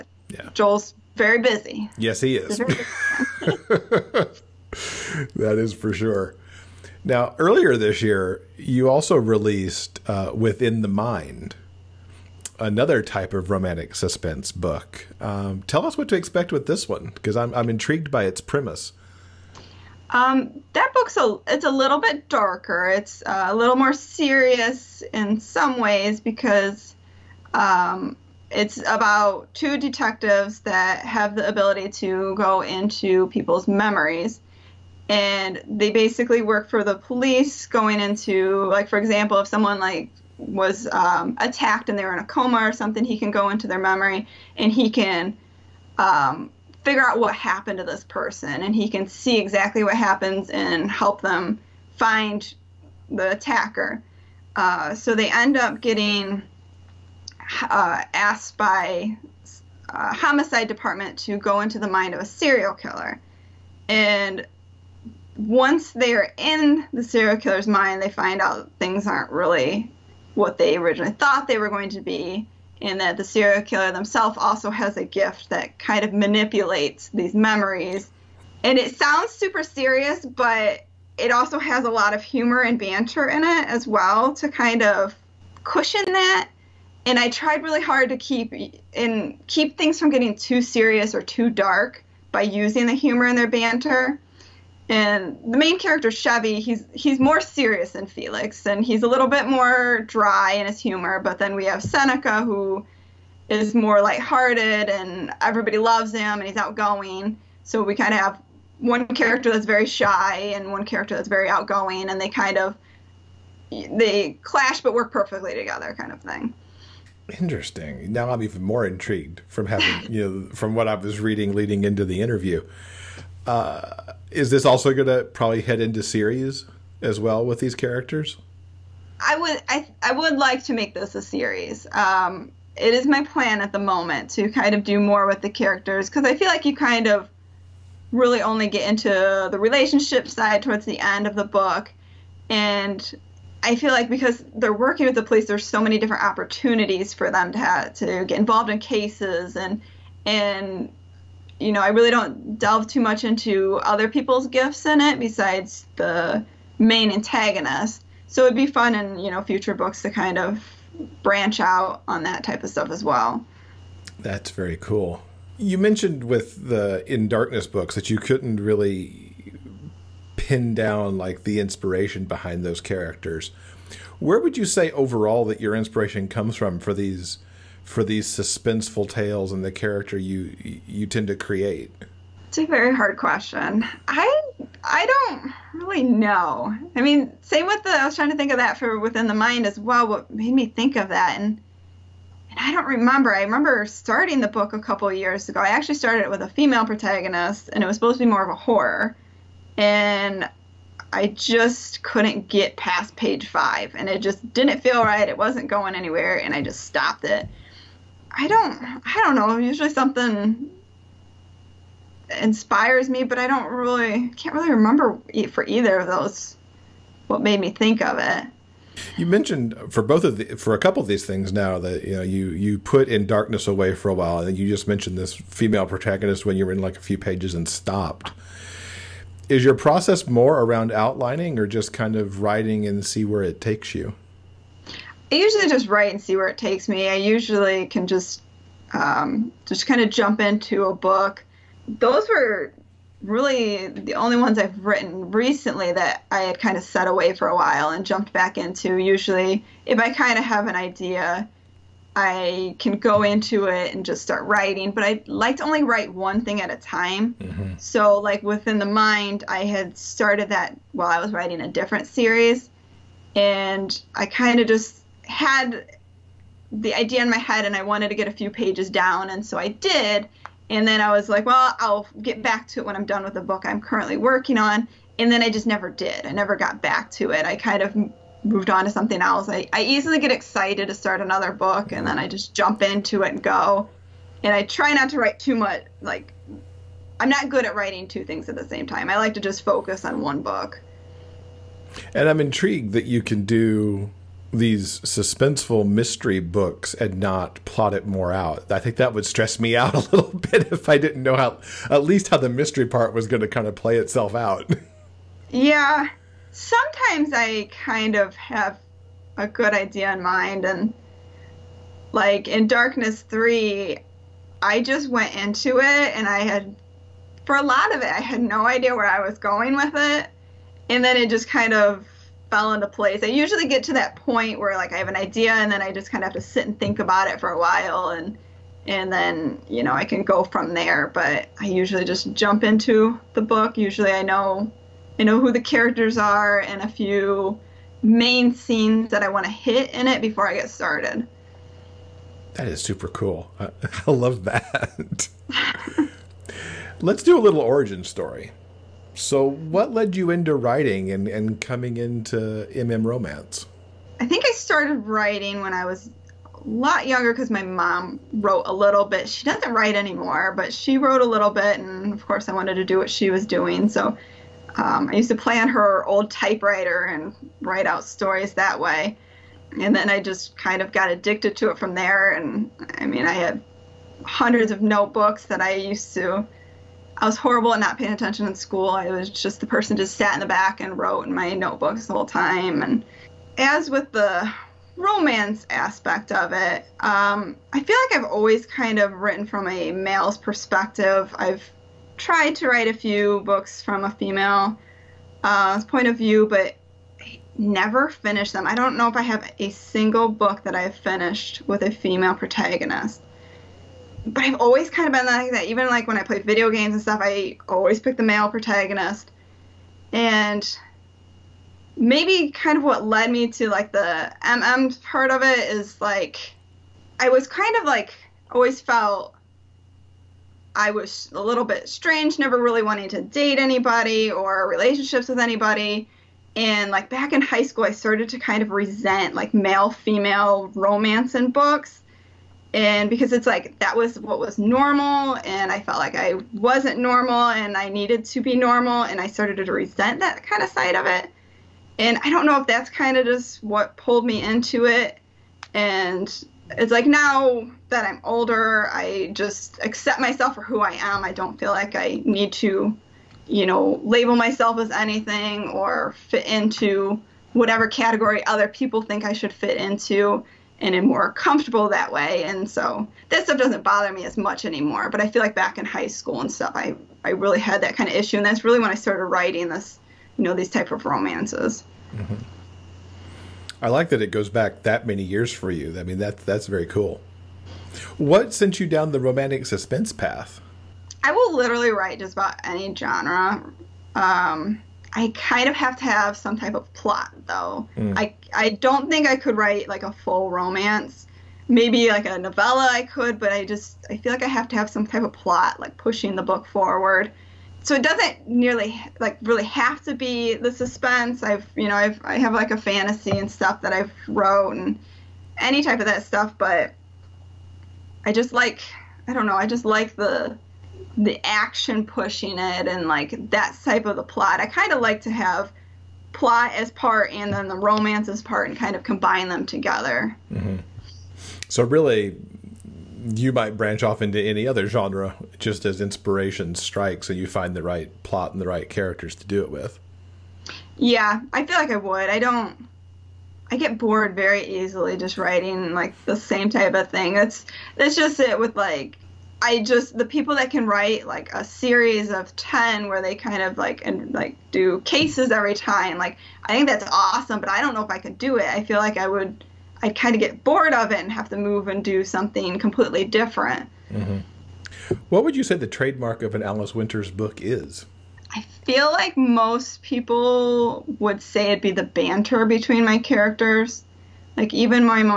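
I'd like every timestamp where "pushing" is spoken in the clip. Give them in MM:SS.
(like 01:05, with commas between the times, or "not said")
08:15, 08:32.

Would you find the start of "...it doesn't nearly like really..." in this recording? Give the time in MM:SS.
08:17.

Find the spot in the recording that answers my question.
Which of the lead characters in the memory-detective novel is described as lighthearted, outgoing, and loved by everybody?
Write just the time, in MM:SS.
01:41.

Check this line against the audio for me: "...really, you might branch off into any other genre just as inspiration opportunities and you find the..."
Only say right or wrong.
wrong.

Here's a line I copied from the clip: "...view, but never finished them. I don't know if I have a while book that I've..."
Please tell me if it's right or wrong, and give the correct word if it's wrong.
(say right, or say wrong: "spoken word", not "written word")
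wrong: "single", not "while".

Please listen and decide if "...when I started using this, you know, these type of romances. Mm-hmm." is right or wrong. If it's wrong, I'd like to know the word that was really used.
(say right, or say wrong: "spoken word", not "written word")
wrong: "writing", not "using".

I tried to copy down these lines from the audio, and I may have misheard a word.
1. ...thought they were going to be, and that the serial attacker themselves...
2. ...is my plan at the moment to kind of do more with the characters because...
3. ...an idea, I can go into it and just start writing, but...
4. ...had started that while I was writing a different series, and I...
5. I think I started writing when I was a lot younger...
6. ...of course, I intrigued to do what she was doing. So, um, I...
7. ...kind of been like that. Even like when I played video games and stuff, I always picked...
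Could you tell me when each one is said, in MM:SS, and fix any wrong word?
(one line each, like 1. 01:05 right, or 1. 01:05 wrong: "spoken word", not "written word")
1. 01:11 wrong: "killer", not "attacker"
2. 02:12 right
3. 04:10 right
4. 04:19 right
5. 05:54 right
6. 06:02 wrong: "wanted", not "intrigued"
7. 06:44 right.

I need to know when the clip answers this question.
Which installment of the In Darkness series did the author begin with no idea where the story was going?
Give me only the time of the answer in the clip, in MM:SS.
05:12.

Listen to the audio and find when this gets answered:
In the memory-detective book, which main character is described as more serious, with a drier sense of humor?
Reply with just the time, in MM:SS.
01:36.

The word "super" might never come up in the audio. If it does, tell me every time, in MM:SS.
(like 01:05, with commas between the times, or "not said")
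01:19, 05:42.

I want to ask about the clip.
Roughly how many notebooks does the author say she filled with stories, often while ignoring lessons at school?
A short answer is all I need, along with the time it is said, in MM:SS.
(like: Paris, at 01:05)
Hundreds, at 06:14.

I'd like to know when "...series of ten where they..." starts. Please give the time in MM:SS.
09:01.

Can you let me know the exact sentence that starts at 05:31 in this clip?
But I usually just jump into the book.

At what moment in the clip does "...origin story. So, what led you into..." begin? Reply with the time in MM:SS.
05:47.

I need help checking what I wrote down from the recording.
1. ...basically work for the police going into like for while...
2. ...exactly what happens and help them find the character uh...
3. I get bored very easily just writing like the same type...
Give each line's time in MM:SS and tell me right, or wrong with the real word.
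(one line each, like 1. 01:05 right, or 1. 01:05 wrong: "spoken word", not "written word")
1. 00:35 wrong: "example", not "while"
2. 00:49 wrong: "attacker", not "character"
3. 08:53 right.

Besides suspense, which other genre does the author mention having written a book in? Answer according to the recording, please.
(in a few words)
Fantasy.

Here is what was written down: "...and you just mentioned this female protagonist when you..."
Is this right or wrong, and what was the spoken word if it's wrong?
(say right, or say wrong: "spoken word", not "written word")
right.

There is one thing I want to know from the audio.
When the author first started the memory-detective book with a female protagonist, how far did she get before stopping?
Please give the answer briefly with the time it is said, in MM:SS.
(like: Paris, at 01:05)
Page 5, at 03:23.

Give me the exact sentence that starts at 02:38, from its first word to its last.
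So it'd be fun in you know future books to kind of branch out on that type of stuff as well.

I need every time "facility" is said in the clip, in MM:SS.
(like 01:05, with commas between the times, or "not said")
not said.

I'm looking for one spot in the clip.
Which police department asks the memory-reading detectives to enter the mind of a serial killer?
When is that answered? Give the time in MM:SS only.
01:00.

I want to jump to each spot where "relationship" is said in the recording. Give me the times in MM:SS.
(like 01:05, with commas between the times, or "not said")
02:19, 07:04.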